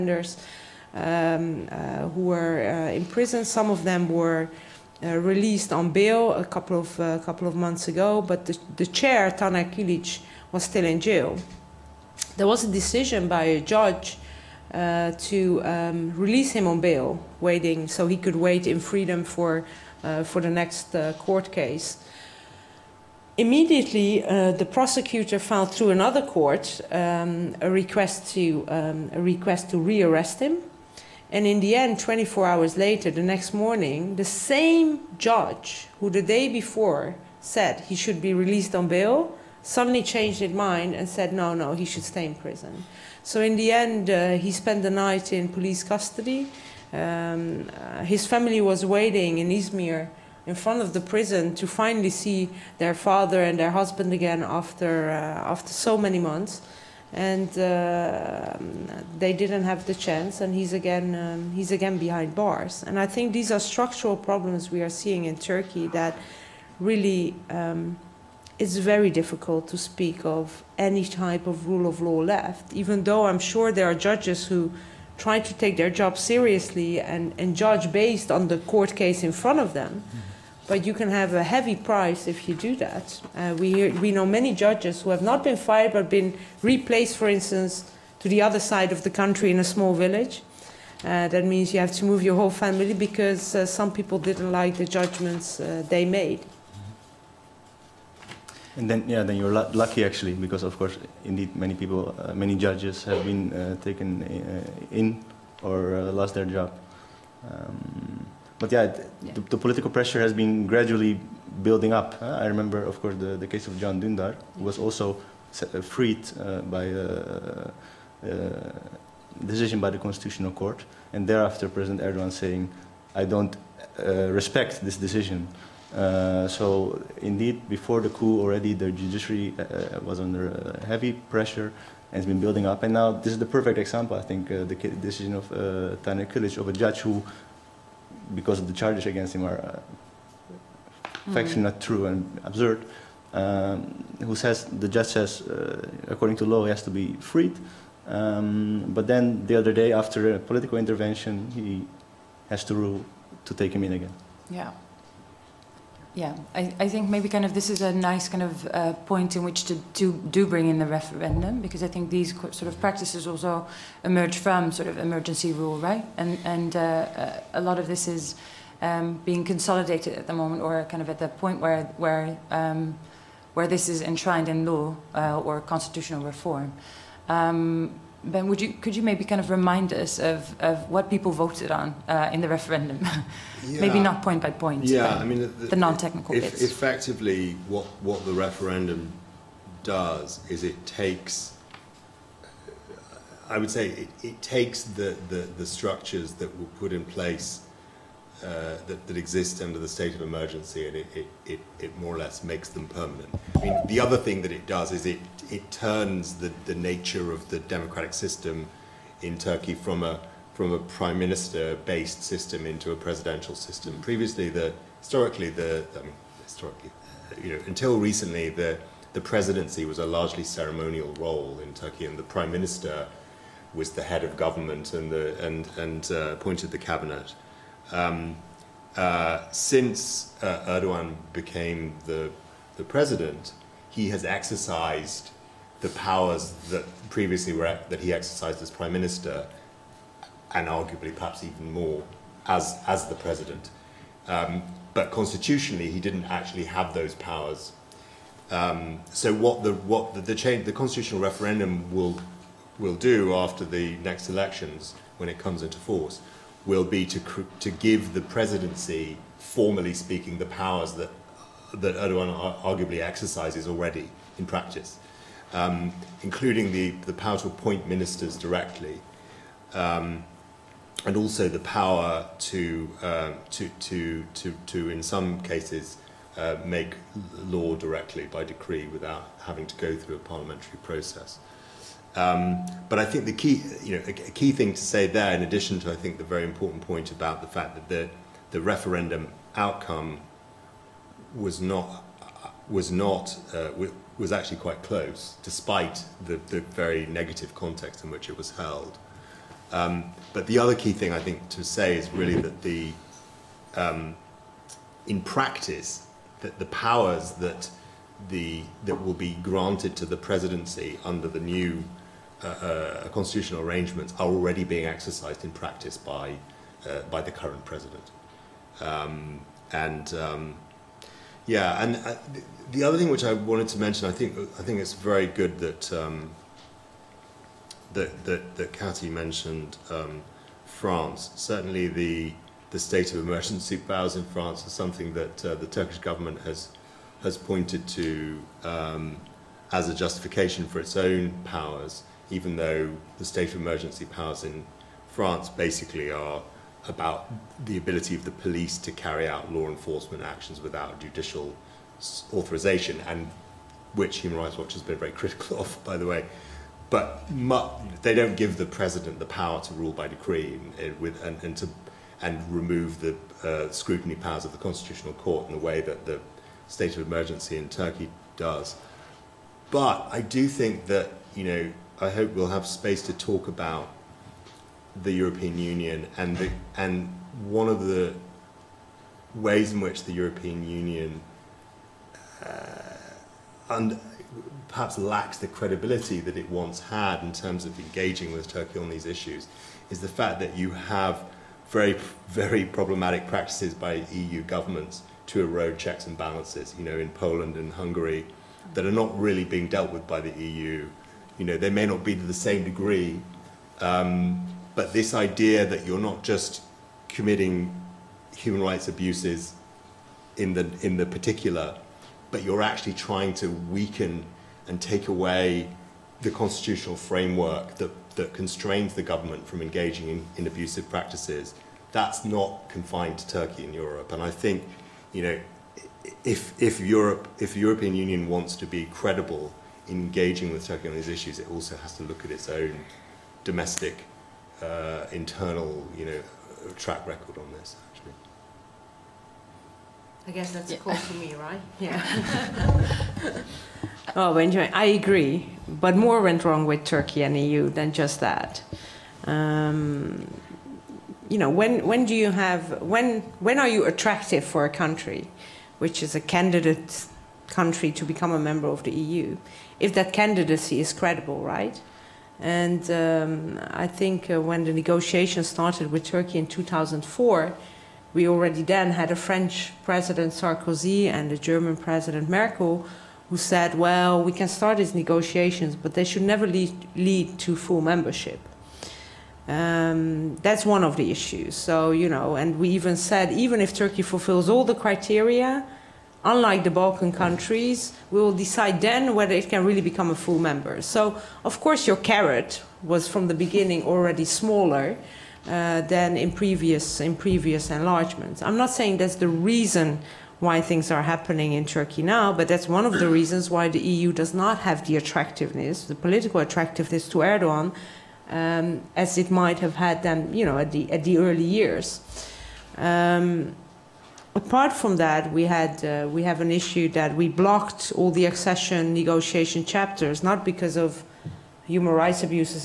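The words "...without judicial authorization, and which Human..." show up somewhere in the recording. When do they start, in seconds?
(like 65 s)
350 s.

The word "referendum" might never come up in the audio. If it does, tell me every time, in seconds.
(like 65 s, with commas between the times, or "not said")
160 s, 182 s, 188 s, 251 s, 288 s.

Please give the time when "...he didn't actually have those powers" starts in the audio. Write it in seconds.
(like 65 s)
245 s.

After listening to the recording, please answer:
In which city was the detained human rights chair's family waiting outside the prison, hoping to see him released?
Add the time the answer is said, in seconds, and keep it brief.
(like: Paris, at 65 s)
Izmir, at 49 s.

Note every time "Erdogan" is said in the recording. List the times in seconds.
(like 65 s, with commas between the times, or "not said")
122 s, 230 s, 261 s, 507 s.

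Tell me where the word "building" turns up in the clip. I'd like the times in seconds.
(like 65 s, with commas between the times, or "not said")
111 s, 132 s.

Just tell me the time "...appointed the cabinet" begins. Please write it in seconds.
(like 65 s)
226 s.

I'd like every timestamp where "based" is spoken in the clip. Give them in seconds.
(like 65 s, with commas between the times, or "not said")
77 s, 211 s.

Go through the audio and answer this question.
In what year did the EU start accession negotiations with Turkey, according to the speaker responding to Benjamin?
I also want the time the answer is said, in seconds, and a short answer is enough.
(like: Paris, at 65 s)
2004, at 466 s.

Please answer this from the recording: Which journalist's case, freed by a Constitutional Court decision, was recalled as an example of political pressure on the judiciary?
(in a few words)
Can Dundar.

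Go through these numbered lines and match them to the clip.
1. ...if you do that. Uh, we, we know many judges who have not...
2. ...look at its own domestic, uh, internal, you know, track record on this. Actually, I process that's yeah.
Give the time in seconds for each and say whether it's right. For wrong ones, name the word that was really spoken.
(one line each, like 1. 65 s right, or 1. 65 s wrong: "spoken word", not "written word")
1. 82 s right
2. 432 s wrong: "guess", not "process".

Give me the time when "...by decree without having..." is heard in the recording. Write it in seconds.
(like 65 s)
278 s.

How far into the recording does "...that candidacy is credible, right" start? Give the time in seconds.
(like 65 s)
459 s.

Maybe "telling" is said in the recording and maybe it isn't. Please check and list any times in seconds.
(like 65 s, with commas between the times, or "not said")
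not said.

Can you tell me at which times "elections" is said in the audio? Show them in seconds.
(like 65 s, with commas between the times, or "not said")
254 s.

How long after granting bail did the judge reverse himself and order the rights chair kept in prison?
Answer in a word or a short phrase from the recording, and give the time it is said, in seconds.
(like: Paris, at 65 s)
24 hours, at 31 s.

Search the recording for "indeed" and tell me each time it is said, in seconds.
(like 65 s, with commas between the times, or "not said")
101 s, 127 s.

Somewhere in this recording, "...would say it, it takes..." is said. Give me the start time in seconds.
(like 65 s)
193 s.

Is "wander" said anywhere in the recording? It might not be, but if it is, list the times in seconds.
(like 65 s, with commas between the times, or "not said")
not said.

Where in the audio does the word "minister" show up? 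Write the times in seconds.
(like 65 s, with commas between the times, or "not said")
211 s, 222 s, 238 s, 267 s.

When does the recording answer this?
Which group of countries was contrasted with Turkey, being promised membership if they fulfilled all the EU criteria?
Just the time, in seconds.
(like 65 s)
486 s.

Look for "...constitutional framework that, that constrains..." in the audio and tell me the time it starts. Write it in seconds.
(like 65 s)
416 s.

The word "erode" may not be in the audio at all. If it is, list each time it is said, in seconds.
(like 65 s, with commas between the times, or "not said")
395 s.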